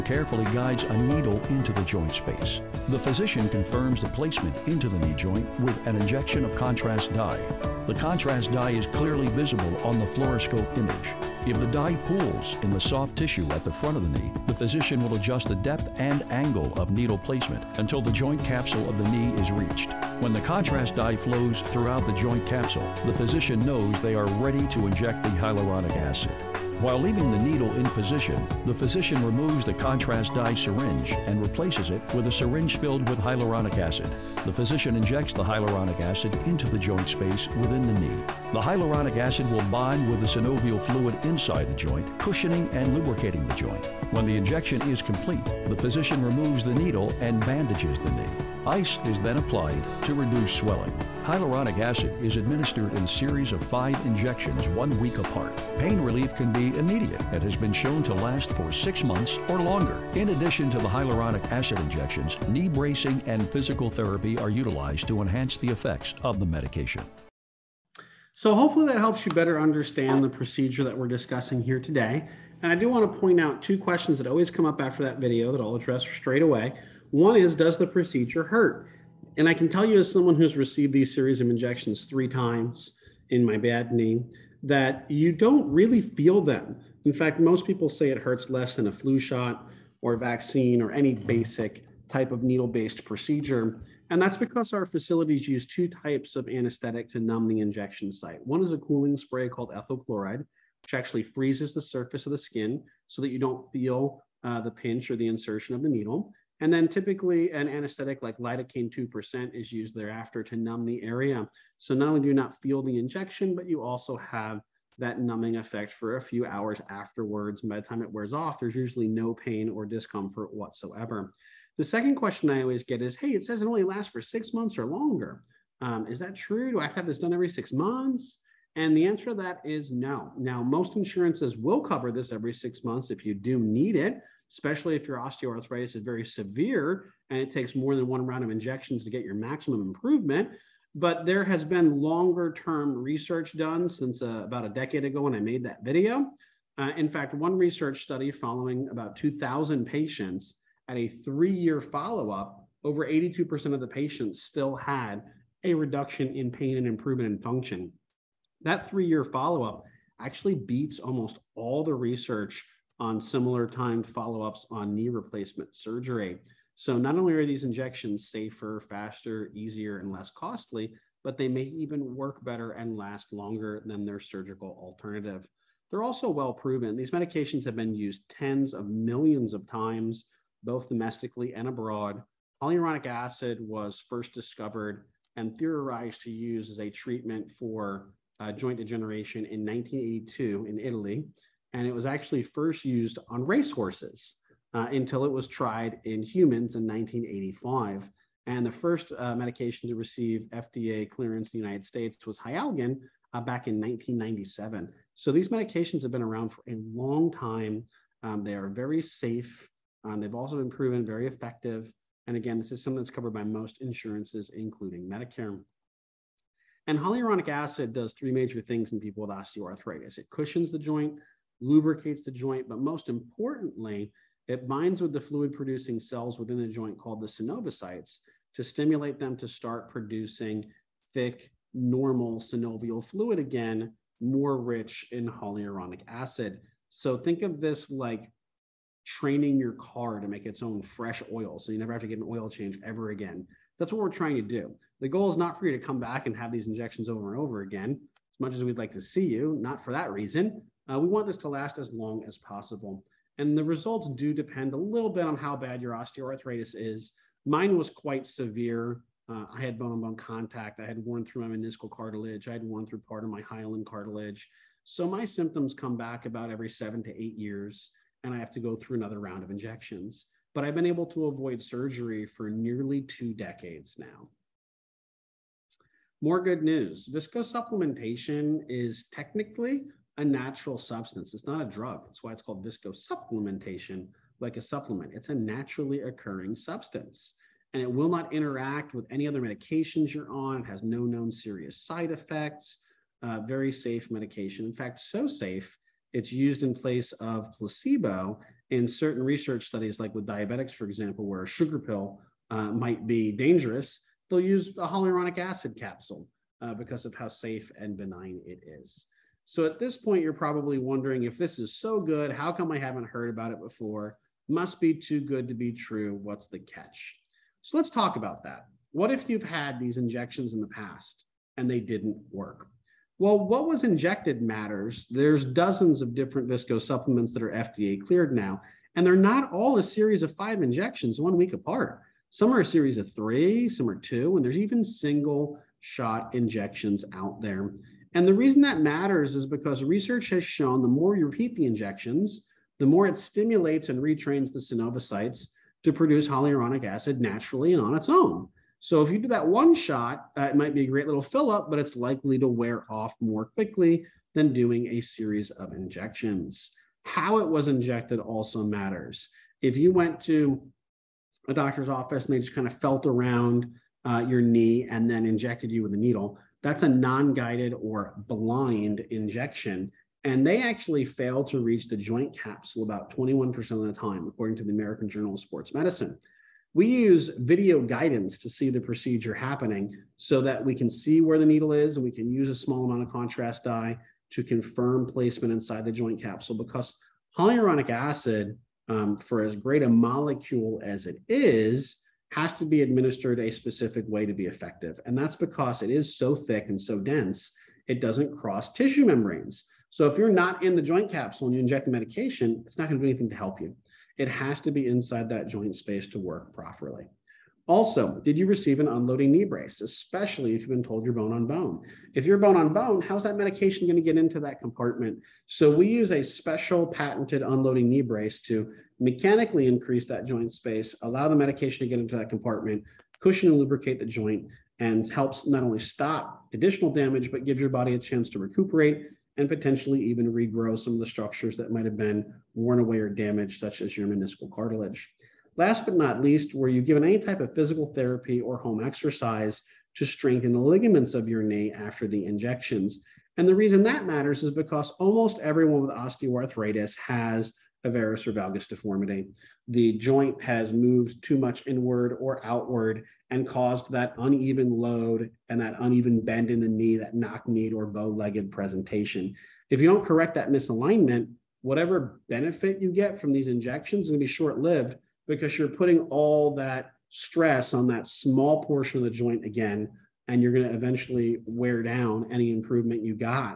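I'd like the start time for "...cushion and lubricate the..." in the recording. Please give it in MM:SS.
07:03.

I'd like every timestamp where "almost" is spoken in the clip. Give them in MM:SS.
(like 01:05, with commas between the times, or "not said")
02:40, 07:24.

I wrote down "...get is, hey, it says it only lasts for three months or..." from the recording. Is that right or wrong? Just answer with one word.
wrong.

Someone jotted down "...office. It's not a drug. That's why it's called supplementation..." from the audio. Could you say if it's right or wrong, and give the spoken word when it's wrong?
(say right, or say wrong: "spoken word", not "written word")
wrong: "substance", not "office".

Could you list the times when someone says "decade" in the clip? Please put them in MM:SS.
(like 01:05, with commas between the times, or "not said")
02:24, 04:33.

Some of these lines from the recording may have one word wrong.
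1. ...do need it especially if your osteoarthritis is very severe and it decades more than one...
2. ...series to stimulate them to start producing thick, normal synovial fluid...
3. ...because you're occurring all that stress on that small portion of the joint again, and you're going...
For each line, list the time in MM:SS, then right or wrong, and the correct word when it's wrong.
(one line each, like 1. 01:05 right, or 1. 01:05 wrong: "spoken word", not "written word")
1. 02:13 wrong: "takes", not "decades"
2. 03:47 wrong: "synoviocytes", not "series"
3. 07:45 wrong: "putting", not "occurring".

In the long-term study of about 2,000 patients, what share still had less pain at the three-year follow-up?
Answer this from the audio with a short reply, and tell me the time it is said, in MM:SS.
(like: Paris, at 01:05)
over 82%, at 02:32.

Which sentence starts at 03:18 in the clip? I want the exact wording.
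And the first uh, medication to receive FDA clearance in the United States was Hyalgan uh, back in 1997.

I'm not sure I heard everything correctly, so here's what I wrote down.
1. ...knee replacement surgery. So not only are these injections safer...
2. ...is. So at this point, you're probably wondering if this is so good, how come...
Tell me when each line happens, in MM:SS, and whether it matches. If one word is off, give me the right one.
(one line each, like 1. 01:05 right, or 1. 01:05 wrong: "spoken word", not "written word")
1. 02:44 right
2. 05:08 right.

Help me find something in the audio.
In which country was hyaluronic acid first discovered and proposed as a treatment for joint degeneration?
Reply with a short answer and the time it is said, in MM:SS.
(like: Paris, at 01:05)
Italy, at 03:10.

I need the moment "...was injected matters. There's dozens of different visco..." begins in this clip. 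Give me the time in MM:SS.
05:23.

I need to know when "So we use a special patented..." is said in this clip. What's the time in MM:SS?
06:55.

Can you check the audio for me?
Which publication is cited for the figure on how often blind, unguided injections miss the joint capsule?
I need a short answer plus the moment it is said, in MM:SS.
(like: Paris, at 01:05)
American Journal of Sports Medicine, at 06:14.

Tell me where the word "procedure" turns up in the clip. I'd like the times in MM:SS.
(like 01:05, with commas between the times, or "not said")
01:10, 01:17, 01:33, 06:18.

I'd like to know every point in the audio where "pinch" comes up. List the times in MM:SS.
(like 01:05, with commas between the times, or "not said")
01:44.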